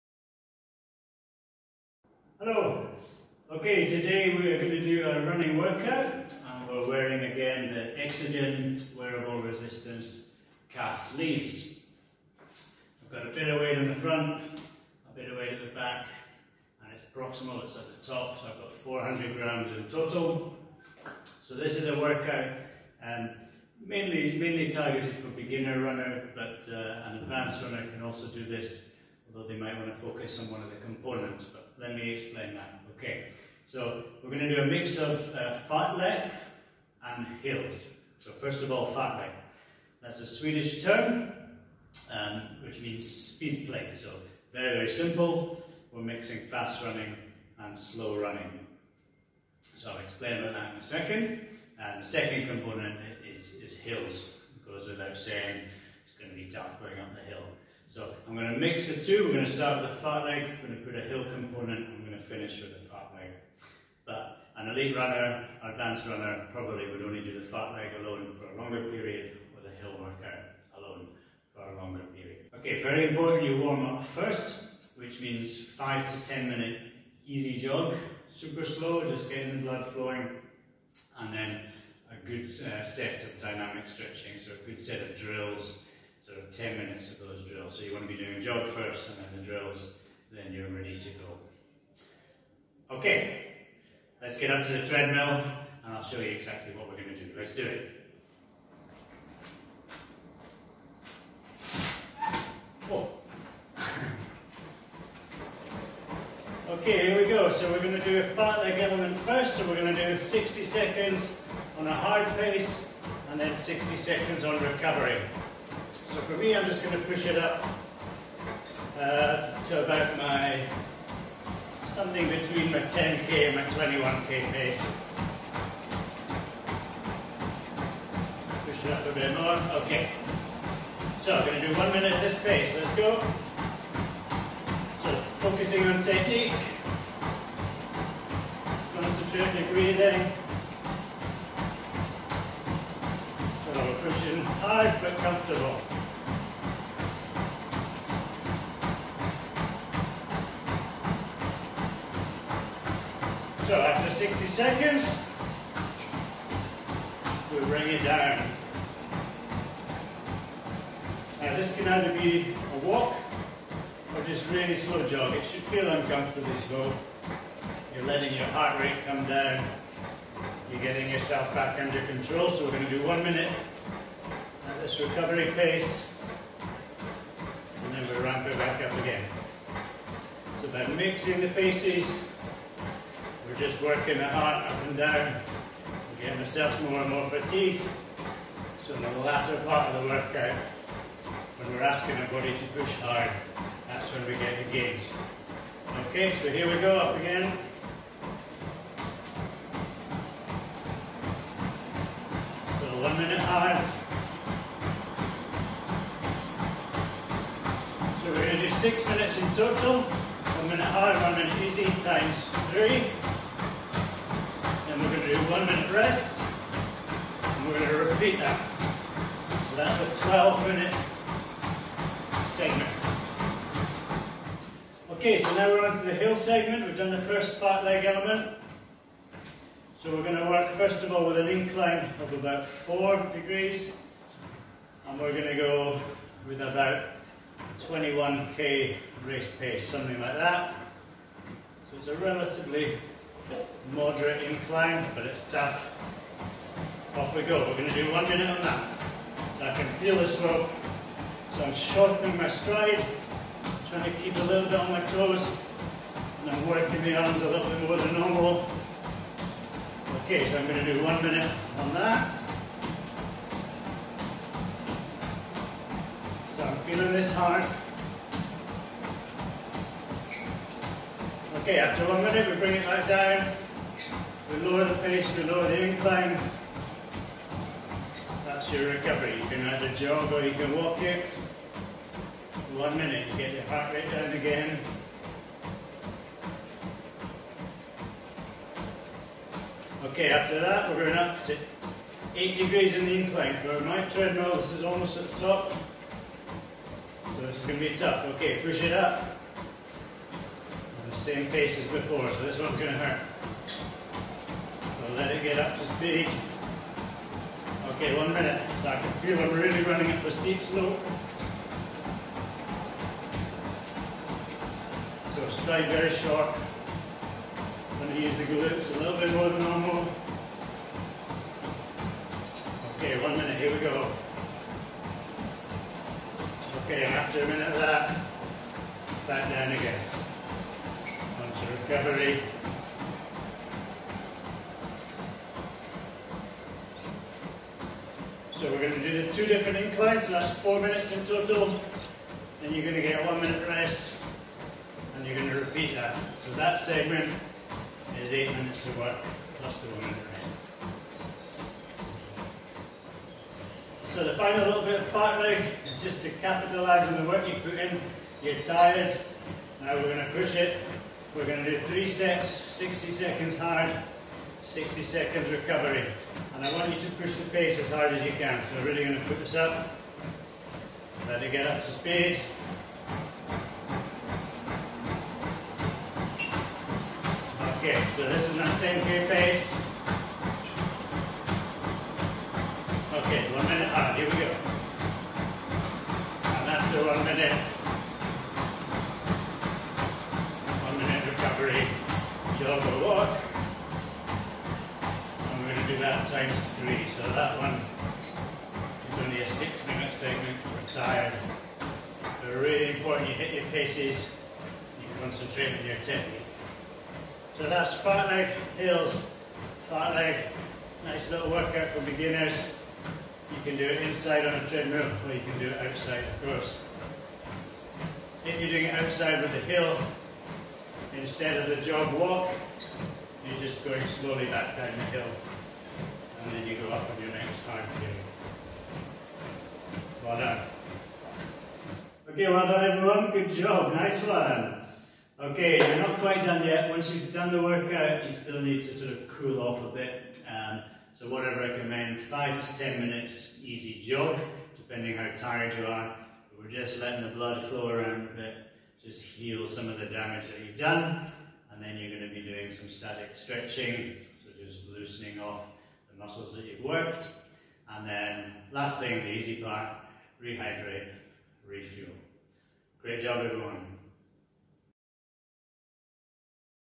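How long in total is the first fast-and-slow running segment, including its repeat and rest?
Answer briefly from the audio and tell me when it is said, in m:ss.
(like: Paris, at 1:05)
12 minutes, at 3:40.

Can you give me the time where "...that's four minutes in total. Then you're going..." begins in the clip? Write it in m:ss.
5:40.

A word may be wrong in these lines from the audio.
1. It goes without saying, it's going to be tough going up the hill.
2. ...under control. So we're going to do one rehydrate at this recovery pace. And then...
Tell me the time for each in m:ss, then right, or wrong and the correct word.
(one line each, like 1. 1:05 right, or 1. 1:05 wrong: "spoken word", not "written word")
1. 0:54 right
2. 2:51 wrong: "minute", not "rehydrate".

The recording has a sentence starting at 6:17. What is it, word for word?
Okay, so this is that 10k pace.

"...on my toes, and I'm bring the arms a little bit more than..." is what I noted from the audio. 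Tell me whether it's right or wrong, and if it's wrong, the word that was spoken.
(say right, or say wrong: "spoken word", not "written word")
wrong: "working", not "bring".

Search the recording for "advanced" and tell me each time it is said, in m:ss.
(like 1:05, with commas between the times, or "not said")
0:27, 1:05.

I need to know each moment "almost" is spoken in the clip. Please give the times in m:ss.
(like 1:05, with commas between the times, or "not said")
4:54.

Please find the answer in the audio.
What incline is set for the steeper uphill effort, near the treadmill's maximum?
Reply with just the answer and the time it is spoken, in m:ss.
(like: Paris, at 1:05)
8 degrees, at 4:52.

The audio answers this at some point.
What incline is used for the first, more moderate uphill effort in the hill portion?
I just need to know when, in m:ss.
3:52.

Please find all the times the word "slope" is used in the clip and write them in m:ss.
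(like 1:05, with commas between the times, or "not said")
4:10, 5:10.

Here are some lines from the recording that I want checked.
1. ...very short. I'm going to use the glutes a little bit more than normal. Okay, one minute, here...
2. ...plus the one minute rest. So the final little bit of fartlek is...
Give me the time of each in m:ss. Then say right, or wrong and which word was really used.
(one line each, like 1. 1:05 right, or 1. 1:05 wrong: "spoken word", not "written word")
1. 5:15 right
2. 5:49 right.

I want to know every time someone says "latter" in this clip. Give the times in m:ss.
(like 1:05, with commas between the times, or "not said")
3:09.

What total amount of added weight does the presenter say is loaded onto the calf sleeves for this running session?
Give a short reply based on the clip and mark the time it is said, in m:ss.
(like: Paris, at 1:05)
400 grams, at 0:18.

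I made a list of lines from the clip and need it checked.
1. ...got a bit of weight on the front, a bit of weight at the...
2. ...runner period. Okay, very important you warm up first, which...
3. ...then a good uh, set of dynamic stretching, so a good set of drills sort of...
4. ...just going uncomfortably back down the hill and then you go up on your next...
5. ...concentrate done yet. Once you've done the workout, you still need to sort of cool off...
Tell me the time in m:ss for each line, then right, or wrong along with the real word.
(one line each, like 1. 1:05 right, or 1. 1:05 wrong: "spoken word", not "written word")
1. 0:13 right
2. 1:11 wrong: "longer", not "runner"
3. 1:21 right
4. 7:03 wrong: "slowly", not "uncomfortably"
5. 7:16 wrong: "quite", not "concentrate".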